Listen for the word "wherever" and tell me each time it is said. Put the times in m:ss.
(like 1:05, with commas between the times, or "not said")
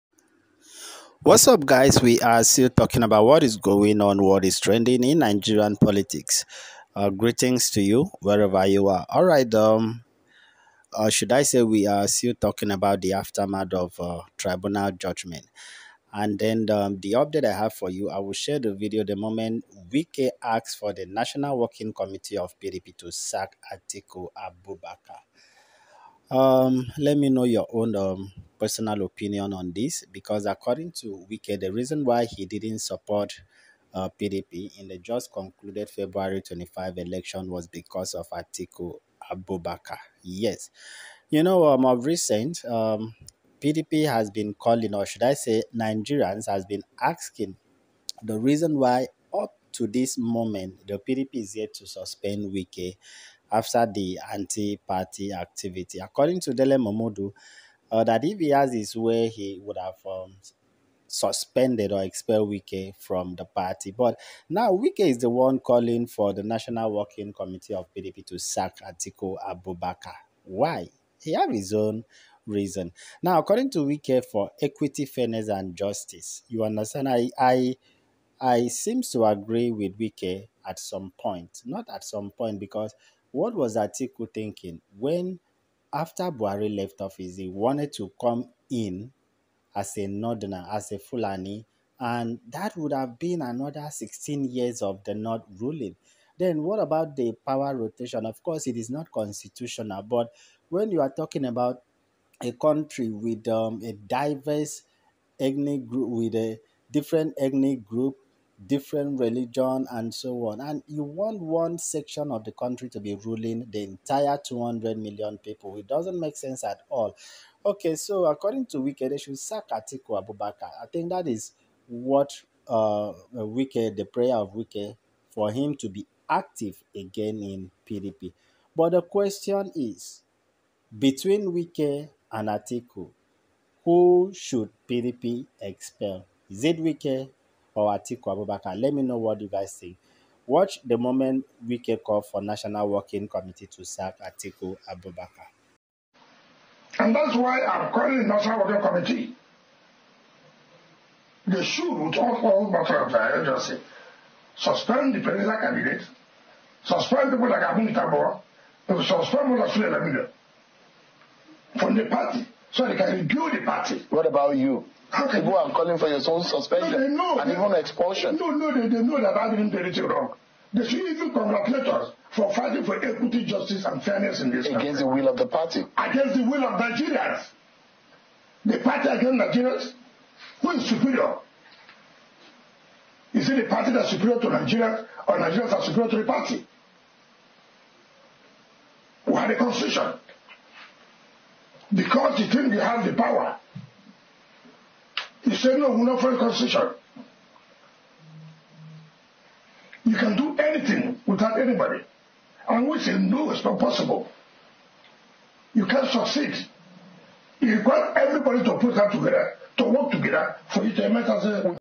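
0:08.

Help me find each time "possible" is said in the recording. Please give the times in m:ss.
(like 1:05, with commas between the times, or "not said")
3:23.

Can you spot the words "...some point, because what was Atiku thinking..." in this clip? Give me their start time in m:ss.
1:22.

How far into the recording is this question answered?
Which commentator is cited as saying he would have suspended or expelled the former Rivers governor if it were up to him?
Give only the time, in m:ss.
0:56.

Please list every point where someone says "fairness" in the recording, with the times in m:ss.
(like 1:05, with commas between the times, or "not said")
1:15, 2:54.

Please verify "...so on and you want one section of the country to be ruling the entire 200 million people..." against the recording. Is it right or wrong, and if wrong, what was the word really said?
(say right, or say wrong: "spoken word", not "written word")
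right.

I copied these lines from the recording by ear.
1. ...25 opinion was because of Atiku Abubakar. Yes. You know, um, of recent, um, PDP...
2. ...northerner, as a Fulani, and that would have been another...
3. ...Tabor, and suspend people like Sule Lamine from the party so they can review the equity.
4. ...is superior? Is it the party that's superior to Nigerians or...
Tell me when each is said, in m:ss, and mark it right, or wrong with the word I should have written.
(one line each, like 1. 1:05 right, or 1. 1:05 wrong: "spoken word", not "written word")
1. 0:36 wrong: "election", not "opinion"
2. 1:30 right
3. 2:37 wrong: "party", not "equity"
4. 3:00 right.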